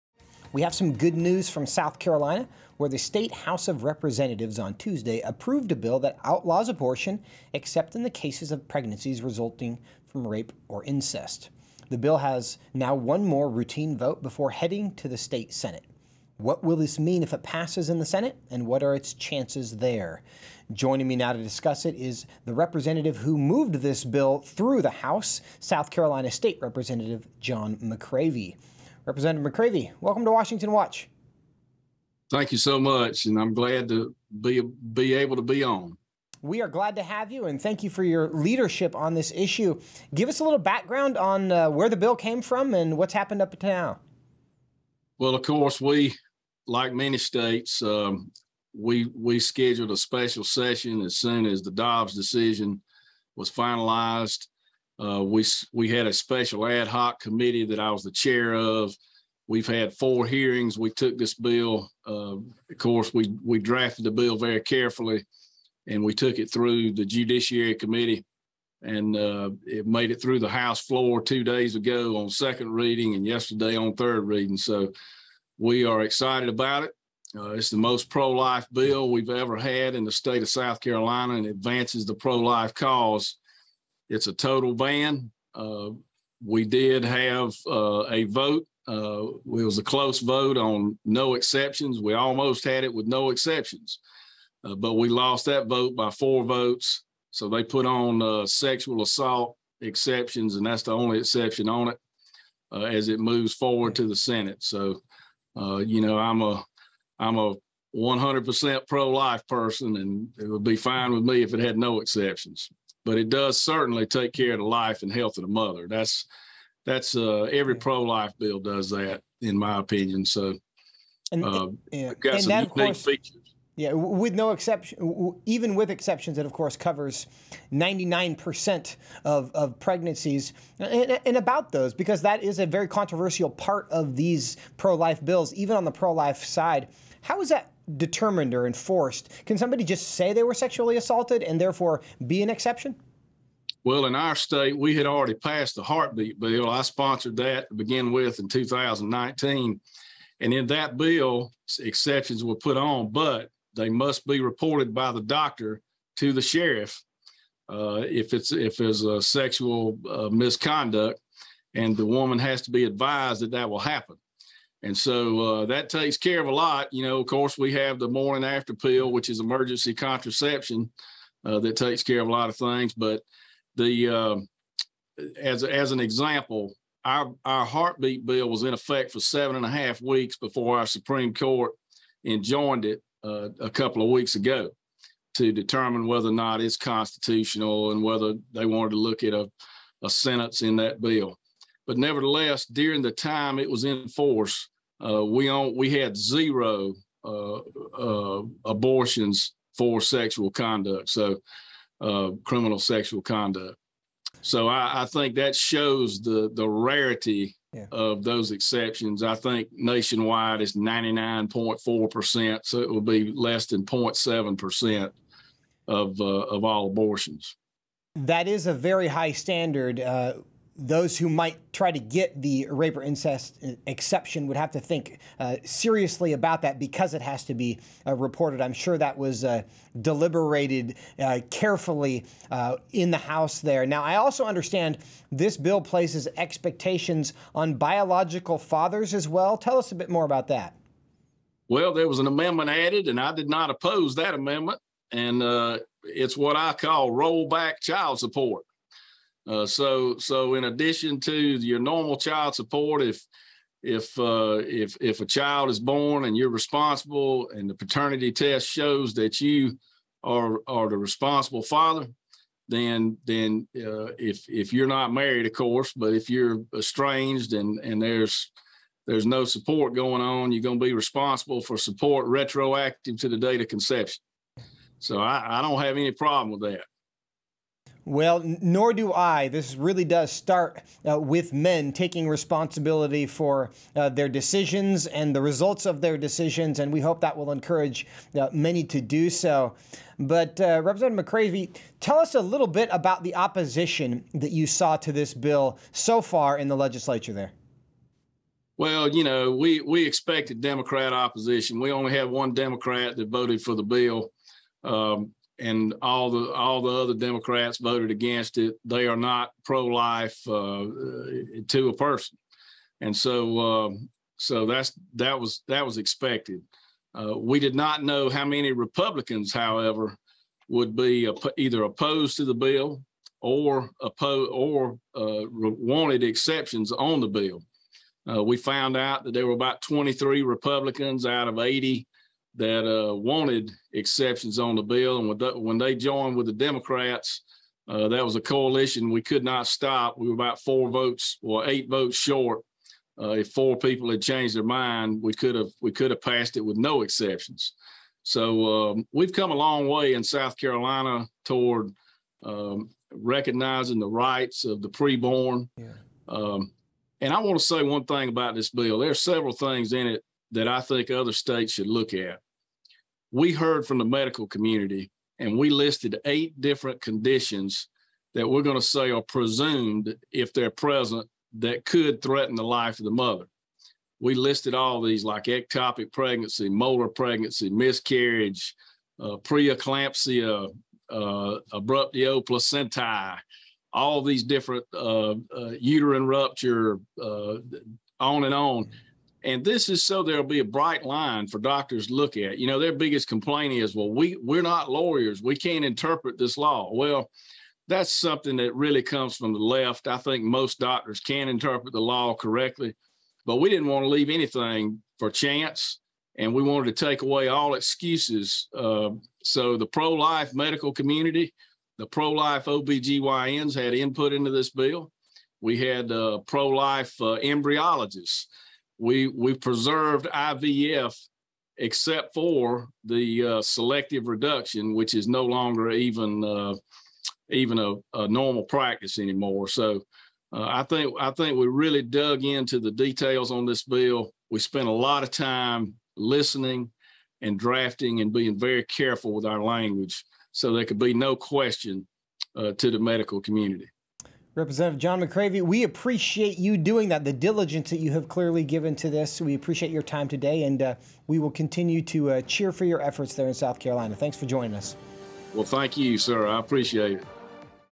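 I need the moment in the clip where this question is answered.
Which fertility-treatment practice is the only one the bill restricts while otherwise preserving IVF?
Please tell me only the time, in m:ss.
7:03.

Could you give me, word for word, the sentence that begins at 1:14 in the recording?
So we are excited about it.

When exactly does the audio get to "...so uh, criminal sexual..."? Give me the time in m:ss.
3:21.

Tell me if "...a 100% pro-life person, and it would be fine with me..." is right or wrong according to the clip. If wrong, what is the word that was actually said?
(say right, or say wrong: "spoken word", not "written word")
right.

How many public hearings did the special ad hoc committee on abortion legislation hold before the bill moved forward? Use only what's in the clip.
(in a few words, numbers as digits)
4.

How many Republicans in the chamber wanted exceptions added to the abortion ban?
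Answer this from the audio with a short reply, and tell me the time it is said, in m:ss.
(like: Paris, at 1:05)
About 23, at 5:29.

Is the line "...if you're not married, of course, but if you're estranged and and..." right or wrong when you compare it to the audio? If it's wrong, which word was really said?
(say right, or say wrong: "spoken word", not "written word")
right.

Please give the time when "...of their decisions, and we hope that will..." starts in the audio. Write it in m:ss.
4:45.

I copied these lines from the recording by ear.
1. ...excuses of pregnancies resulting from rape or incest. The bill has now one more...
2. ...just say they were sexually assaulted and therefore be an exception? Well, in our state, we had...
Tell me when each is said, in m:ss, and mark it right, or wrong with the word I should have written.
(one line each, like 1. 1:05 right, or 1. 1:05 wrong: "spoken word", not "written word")
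1. 0:08 wrong: "cases", not "excuses"
2. 2:19 right.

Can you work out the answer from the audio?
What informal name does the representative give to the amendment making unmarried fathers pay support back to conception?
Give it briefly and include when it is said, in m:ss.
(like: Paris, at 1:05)
Rollback child support, at 4:07.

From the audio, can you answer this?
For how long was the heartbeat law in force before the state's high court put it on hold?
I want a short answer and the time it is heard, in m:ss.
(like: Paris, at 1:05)
7.5 weeks, at 2:59.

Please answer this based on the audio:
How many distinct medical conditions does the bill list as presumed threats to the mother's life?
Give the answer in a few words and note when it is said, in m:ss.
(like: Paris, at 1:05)
8, at 6:06.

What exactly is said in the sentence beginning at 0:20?
Joining me now to discuss it is the representative who moved this bill through the House, South Carolina State Representative John McCravy.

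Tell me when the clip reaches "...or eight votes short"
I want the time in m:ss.
5:41.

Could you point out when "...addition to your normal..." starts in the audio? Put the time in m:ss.
4:10.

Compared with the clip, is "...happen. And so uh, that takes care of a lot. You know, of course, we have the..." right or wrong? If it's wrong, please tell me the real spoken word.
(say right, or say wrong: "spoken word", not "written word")
right.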